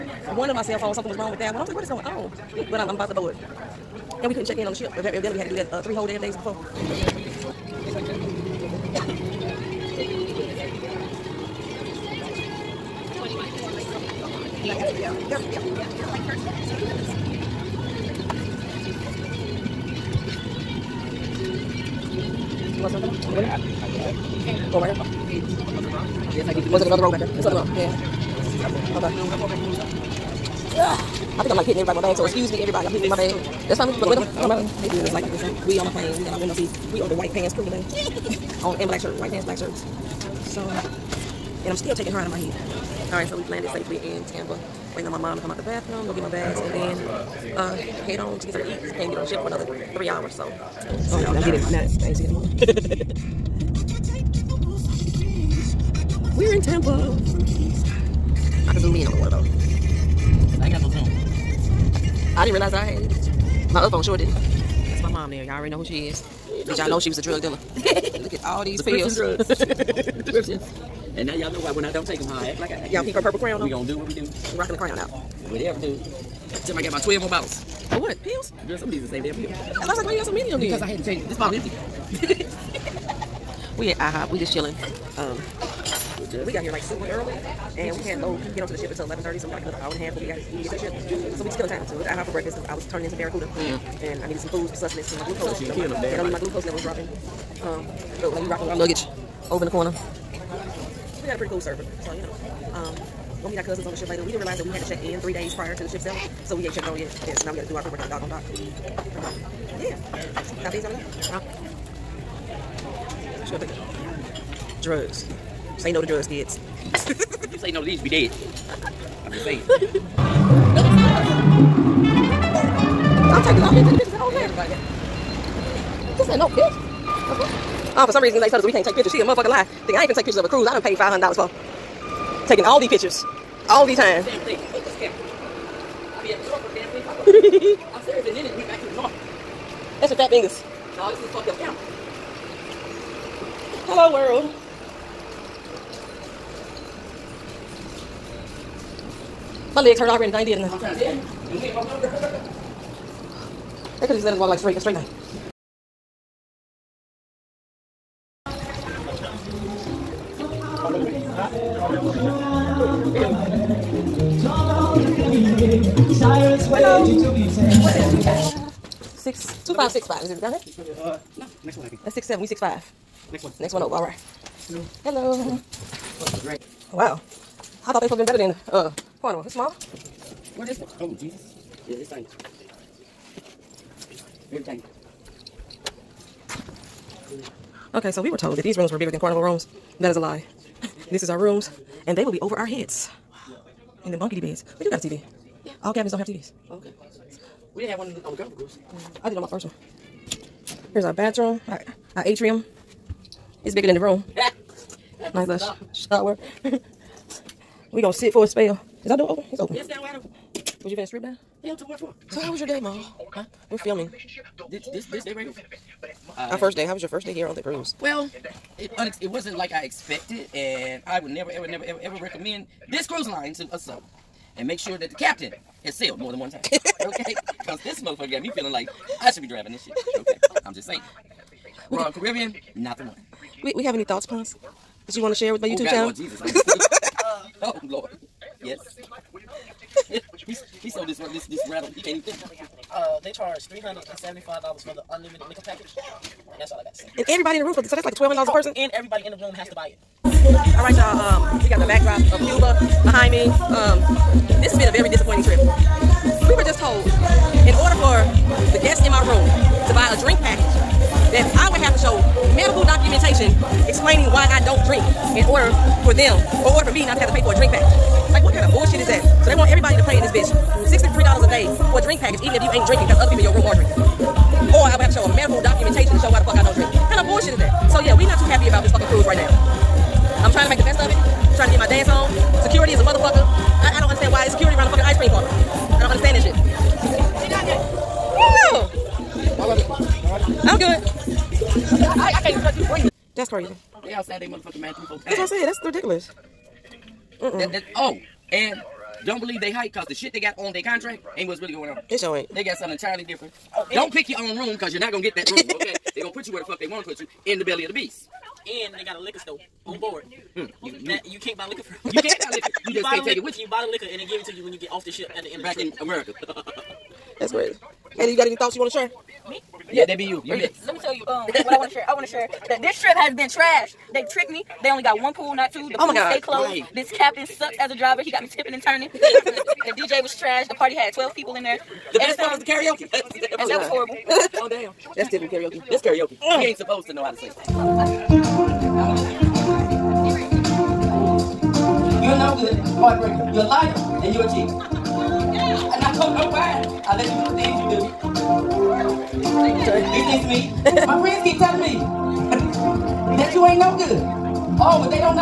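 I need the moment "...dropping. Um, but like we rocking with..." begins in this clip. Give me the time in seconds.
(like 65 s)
96 s.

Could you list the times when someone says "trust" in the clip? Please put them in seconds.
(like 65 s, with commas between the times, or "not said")
292 s.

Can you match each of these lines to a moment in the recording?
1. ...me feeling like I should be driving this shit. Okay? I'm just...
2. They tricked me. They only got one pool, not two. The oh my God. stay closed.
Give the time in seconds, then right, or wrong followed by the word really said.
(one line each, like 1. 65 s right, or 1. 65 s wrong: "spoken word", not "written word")
1. 228 s right
2. 324 s right.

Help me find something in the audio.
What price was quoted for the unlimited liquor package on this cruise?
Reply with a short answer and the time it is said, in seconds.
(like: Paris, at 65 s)
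$375, at 243 s.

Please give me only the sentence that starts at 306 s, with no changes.
They're going to put you where the fuck they want to put you in the belly of the beast.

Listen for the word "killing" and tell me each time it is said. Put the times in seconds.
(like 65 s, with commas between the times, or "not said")
91 s, 95 s.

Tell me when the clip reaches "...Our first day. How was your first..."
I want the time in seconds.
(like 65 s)
216 s.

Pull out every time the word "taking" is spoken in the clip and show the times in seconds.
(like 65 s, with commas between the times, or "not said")
41 s, 132 s.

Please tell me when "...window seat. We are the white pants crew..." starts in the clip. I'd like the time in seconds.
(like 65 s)
36 s.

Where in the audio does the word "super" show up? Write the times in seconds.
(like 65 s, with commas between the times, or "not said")
86 s.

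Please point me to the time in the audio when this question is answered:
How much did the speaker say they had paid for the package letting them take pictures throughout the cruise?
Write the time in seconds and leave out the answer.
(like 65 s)
130 s.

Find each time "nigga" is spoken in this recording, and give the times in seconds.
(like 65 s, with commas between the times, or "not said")
not said.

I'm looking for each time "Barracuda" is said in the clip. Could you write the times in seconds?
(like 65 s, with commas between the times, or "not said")
93 s.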